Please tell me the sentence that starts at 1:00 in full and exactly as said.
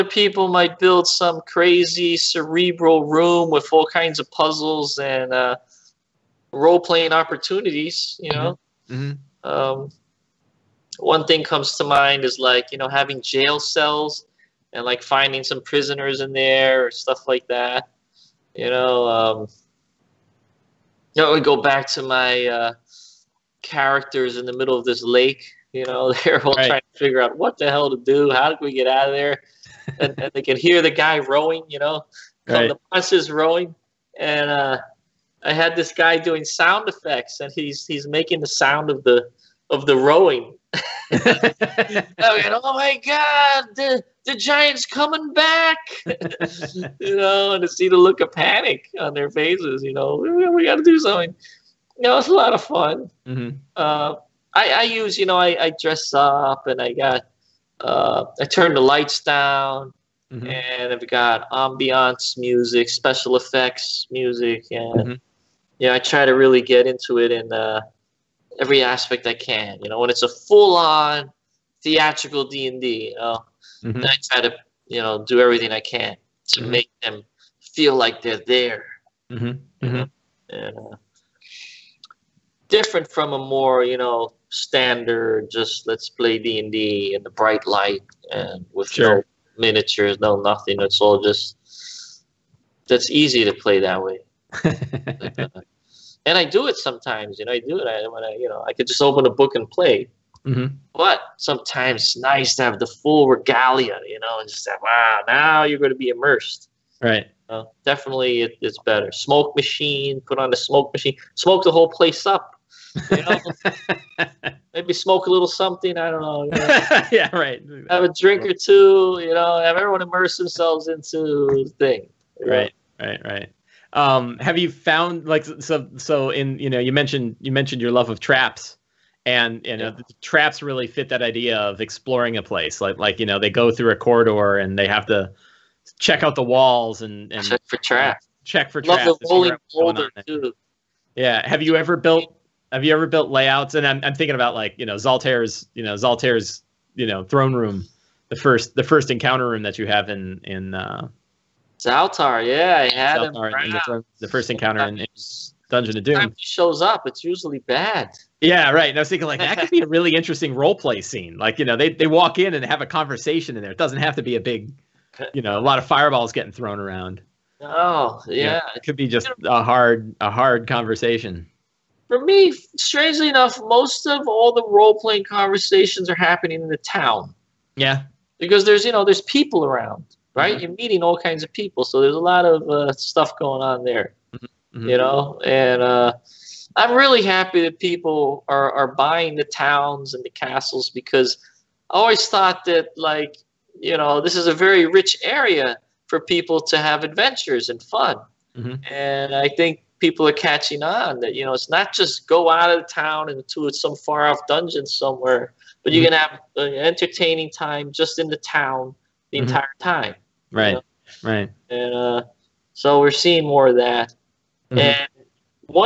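and I've got ambiance music, special effects music.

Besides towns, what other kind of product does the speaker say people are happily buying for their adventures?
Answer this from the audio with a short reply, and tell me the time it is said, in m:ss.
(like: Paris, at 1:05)
Castles, at 3:10.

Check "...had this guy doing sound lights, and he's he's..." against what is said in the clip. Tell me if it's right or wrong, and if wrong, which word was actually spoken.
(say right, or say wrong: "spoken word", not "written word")
wrong: "effects", not "lights".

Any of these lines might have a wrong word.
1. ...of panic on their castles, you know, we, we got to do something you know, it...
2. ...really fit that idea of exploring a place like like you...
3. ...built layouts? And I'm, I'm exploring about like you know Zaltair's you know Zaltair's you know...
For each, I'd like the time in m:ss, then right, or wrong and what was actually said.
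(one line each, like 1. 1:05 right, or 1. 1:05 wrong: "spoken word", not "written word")
1. 0:48 wrong: "faces", not "castles"
2. 2:10 right
3. 2:23 wrong: "thinking", not "exploring".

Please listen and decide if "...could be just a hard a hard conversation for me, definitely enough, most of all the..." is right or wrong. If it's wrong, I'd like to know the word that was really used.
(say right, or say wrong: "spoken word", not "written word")
wrong: "strangely", not "definitely".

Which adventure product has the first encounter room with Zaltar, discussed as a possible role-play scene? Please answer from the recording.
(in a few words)
Dungeon of Doom.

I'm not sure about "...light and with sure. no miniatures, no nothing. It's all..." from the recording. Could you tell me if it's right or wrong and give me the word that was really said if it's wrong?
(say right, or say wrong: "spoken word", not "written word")
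right.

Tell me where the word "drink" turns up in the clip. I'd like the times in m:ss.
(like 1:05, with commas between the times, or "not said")
1:58.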